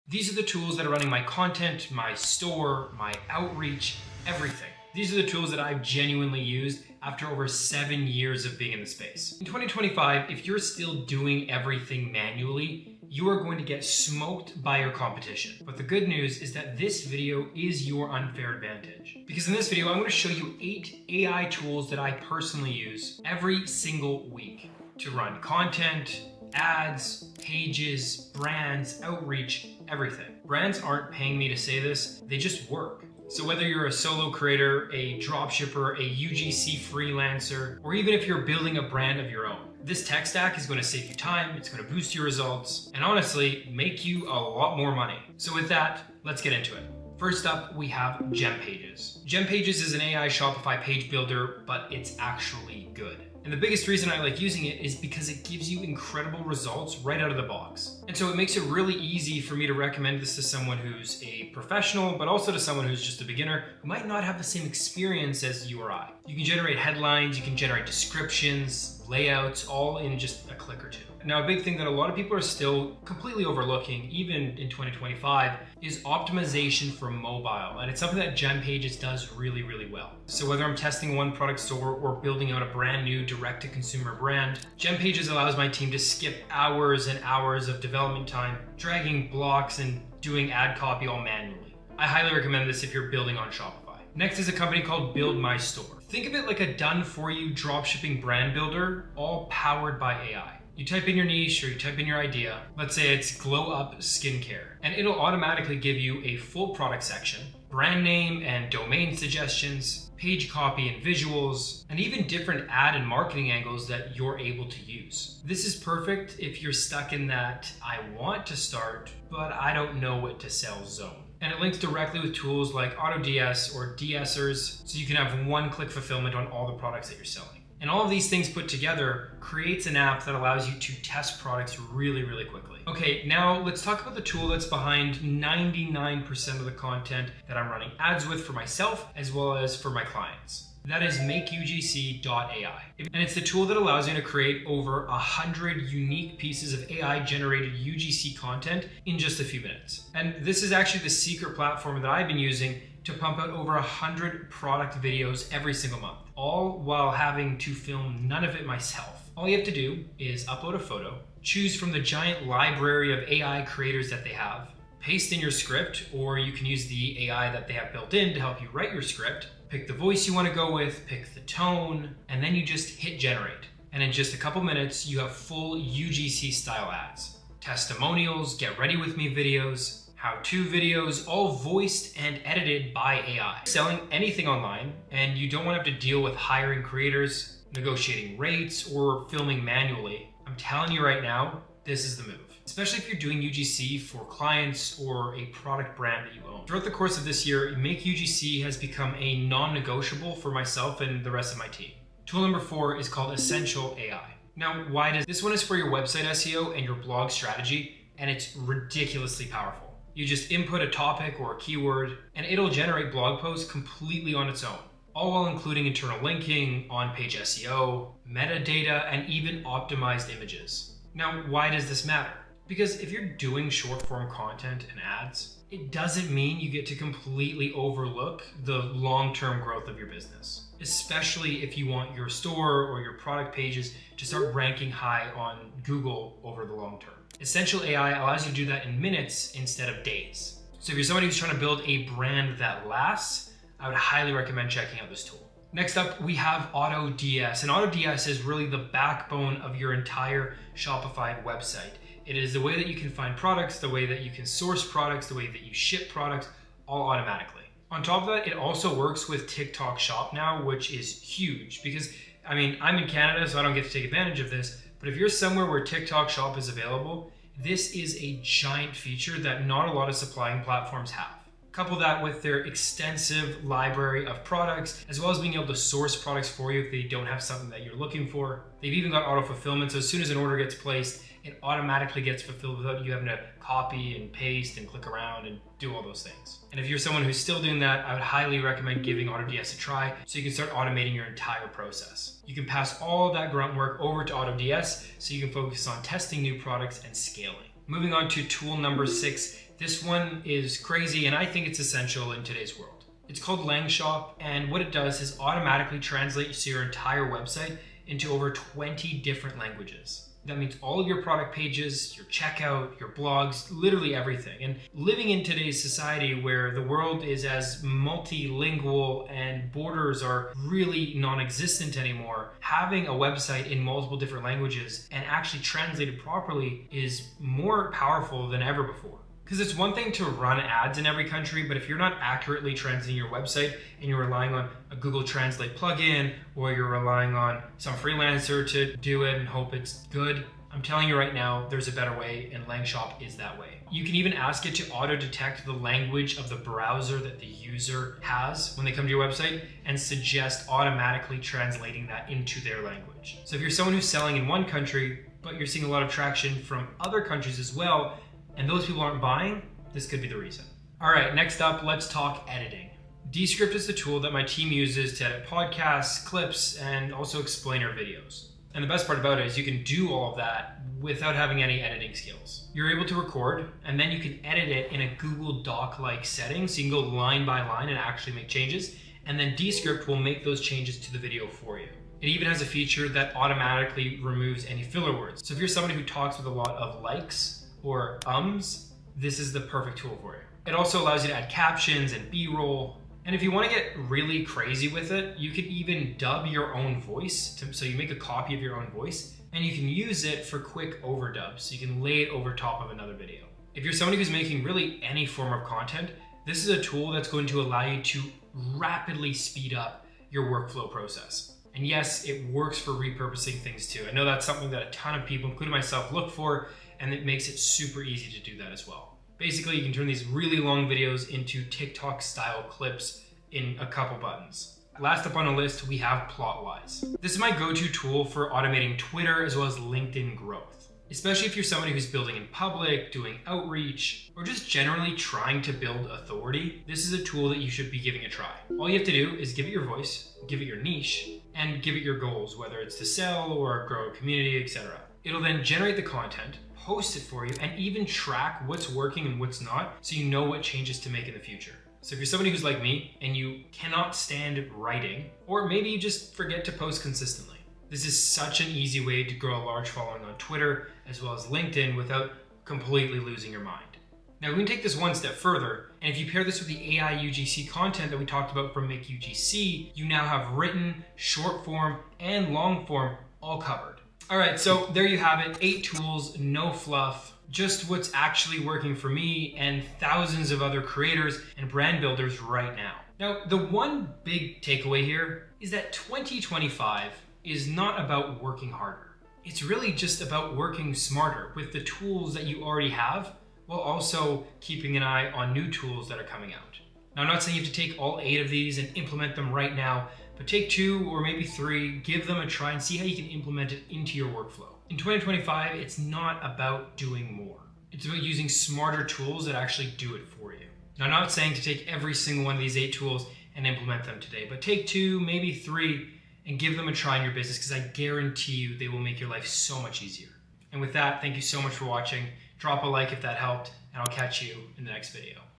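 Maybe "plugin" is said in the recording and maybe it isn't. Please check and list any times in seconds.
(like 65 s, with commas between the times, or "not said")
335 s.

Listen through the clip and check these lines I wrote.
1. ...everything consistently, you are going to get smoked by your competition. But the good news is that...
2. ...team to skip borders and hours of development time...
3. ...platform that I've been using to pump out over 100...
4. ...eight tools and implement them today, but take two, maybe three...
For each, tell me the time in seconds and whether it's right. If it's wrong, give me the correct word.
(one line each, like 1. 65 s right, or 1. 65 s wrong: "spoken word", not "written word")
1. 11 s wrong: "manually", not "consistently"
2. 85 s wrong: "hours", not "borders"
3. 151 s right
4. 512 s right.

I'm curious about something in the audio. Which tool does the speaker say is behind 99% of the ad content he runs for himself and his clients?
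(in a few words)
makeugc.ai.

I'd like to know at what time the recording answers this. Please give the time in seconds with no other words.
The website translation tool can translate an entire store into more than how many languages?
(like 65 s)
308 s.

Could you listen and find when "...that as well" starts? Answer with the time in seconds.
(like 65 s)
418 s.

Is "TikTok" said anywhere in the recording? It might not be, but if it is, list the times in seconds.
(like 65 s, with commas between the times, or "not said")
259 s, 265 s, 421 s.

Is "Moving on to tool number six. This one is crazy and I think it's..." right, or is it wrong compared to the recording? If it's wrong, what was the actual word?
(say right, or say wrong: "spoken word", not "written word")
right.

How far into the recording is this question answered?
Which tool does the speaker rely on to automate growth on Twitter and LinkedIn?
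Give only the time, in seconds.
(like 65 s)
426 s.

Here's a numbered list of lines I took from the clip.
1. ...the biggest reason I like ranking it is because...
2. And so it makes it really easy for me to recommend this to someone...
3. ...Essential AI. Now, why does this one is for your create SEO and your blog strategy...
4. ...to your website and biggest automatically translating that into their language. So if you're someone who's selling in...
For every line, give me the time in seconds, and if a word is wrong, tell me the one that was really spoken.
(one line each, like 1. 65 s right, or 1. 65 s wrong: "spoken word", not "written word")
1. 53 s wrong: "using", not "ranking"
2. 58 s right
3. 203 s wrong: "website", not "create"
4. 349 s wrong: "suggest", not "biggest".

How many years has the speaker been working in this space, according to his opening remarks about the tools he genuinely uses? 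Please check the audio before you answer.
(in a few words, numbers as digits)
7.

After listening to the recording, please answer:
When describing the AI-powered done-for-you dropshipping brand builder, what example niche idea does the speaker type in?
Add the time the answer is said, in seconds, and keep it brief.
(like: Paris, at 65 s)
glow up skincare, at 103 s.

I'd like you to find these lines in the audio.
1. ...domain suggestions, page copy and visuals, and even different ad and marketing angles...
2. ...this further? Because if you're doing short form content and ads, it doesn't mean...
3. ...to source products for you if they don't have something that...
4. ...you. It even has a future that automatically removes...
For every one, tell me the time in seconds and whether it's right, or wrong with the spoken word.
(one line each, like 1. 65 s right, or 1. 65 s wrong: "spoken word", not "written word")
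1. 108 s right
2. 221 s wrong: "matter", not "further"
3. 275 s right
4. 381 s wrong: "feature", not "future".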